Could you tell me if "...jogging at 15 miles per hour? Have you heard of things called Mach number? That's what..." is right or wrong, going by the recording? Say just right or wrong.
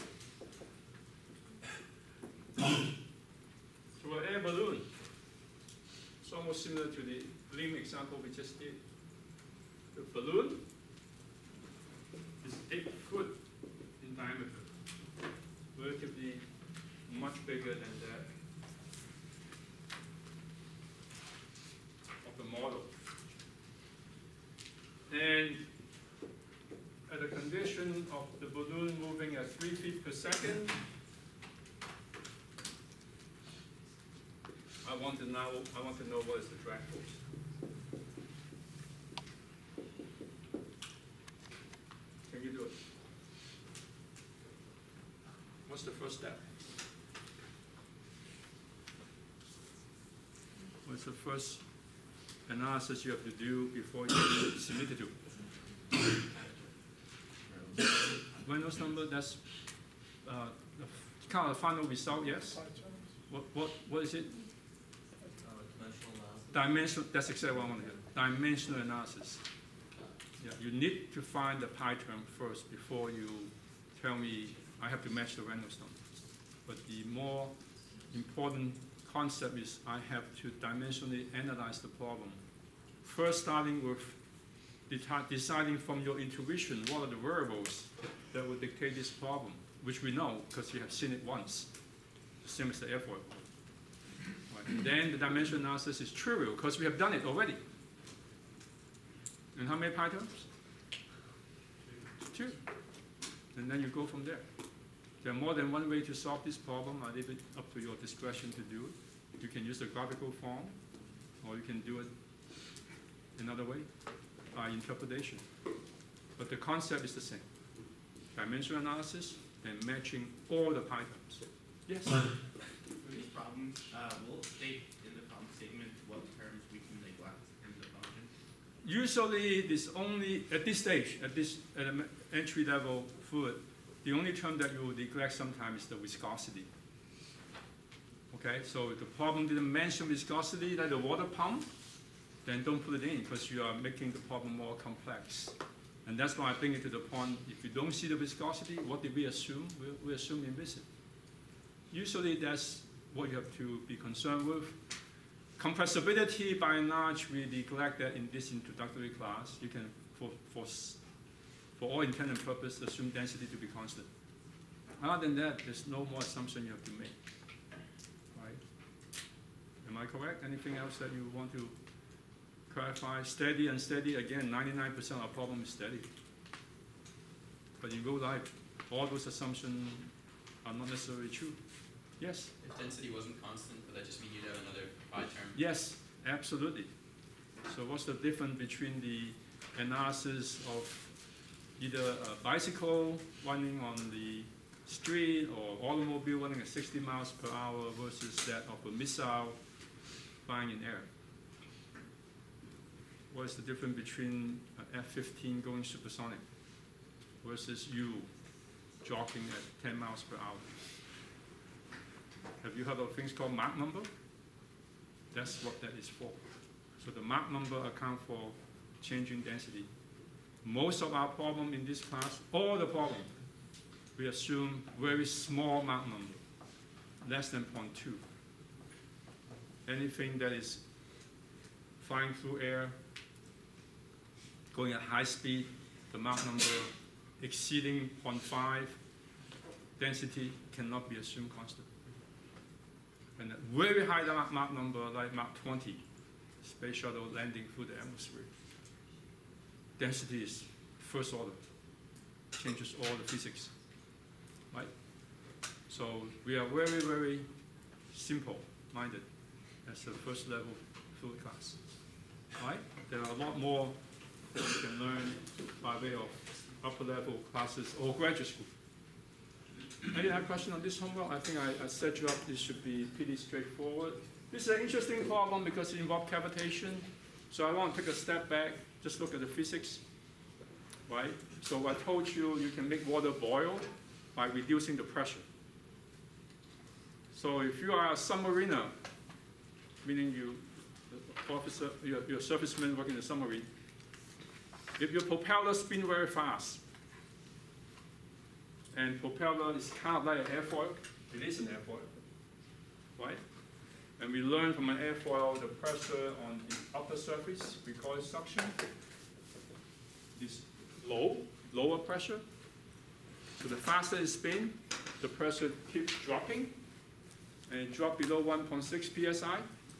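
wrong.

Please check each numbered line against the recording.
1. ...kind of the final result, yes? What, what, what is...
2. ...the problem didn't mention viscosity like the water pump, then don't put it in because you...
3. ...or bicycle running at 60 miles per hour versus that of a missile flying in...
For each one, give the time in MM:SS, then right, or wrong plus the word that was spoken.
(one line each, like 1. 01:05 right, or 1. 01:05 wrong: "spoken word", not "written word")
1. 01:01 right
2. 02:18 right
3. 03:15 wrong: "automobile", not "bicycle".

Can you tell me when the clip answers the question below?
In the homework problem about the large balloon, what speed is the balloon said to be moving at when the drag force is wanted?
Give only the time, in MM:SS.
00:29.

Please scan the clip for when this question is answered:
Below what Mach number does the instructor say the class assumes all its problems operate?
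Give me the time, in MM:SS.
03:47.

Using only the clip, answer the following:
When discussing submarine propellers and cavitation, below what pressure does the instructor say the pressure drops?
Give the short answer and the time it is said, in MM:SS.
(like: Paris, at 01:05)
1.6 psi, at 05:18.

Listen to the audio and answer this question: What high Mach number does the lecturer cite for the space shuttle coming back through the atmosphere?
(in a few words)
Mach 20.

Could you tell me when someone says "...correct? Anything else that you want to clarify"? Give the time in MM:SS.
02:50.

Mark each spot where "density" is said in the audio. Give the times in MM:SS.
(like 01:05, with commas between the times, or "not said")
02:43, 03:02, 03:39, 03:59, 04:09.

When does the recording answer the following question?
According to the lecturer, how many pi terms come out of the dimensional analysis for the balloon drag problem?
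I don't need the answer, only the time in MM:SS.
01:42.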